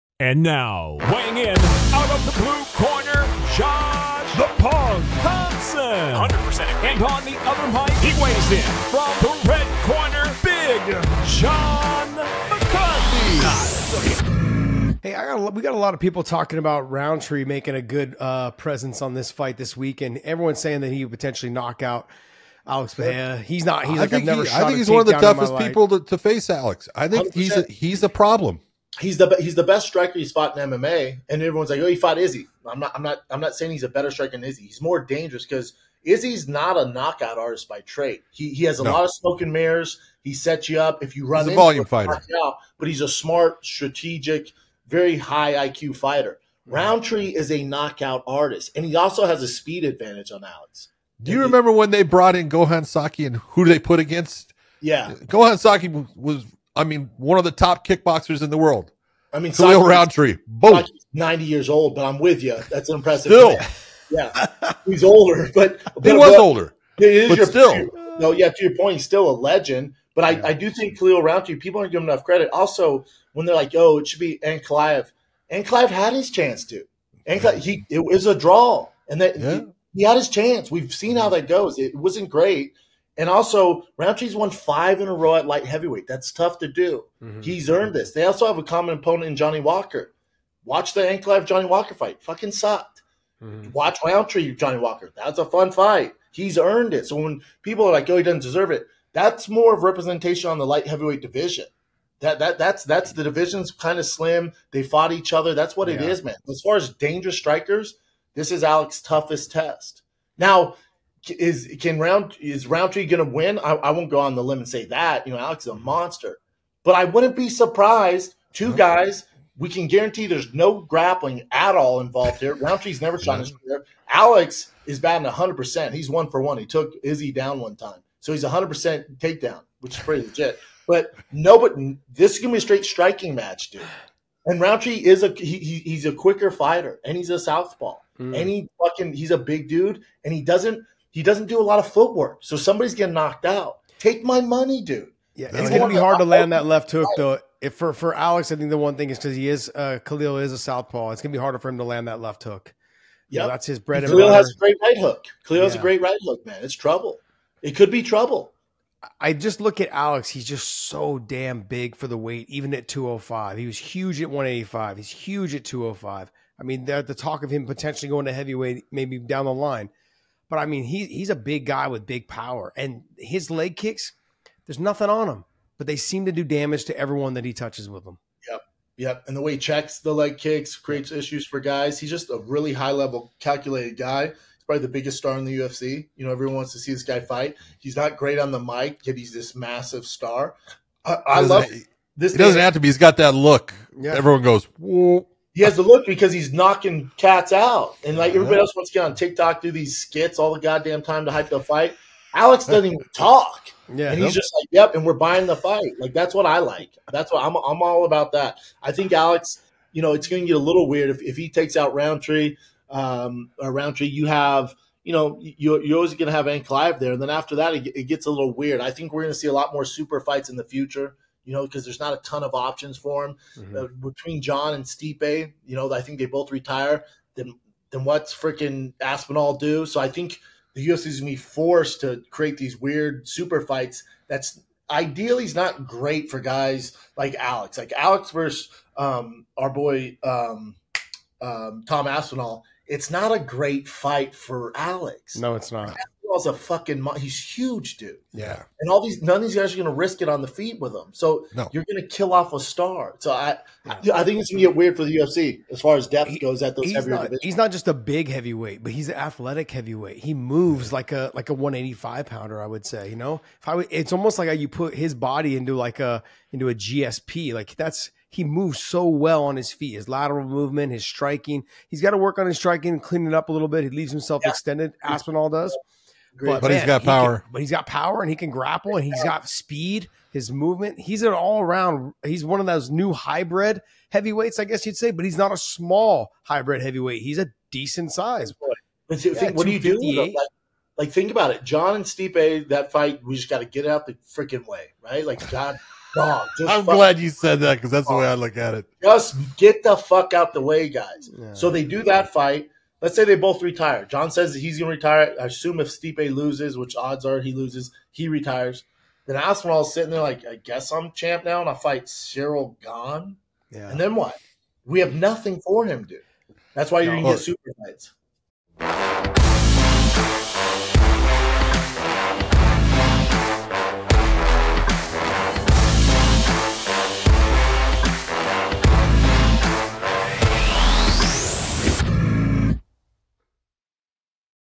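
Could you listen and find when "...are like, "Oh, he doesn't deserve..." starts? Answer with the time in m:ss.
1:37.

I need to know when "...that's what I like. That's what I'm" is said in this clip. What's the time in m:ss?
3:26.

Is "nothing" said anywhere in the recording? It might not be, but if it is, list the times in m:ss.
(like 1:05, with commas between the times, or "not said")
2:54, 5:15.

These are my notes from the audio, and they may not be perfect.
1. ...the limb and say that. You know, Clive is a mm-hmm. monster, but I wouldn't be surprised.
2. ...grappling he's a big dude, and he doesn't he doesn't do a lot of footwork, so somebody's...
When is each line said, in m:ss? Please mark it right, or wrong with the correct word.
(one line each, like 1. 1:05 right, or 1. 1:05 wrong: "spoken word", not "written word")
1. 1:54 wrong: "Alex", not "Clive"
2. 2:18 wrong: "fucking", not "grappling".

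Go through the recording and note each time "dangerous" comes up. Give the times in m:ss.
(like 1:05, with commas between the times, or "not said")
0:34, 1:46.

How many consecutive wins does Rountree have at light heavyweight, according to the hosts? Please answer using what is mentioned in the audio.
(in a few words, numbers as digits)
5.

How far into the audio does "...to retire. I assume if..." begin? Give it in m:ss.
5:04.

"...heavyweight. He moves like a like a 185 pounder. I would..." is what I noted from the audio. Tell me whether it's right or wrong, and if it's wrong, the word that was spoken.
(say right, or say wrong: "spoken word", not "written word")
right.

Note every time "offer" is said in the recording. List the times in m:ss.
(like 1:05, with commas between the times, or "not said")
not said.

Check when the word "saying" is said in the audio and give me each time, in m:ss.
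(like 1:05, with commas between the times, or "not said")
0:20, 0:33.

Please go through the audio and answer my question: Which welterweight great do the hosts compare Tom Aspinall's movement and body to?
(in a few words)
GSP.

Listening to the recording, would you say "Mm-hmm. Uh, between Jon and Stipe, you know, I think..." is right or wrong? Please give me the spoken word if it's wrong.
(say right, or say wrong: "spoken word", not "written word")
right.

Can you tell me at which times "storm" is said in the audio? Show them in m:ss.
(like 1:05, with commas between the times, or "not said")
not said.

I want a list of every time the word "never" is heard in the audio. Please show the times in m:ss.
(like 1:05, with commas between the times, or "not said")
0:24, 2:03.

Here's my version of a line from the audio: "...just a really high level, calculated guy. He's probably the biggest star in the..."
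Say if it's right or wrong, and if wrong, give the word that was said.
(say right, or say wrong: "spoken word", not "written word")
right.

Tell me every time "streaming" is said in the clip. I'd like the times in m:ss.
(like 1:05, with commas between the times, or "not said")
not said.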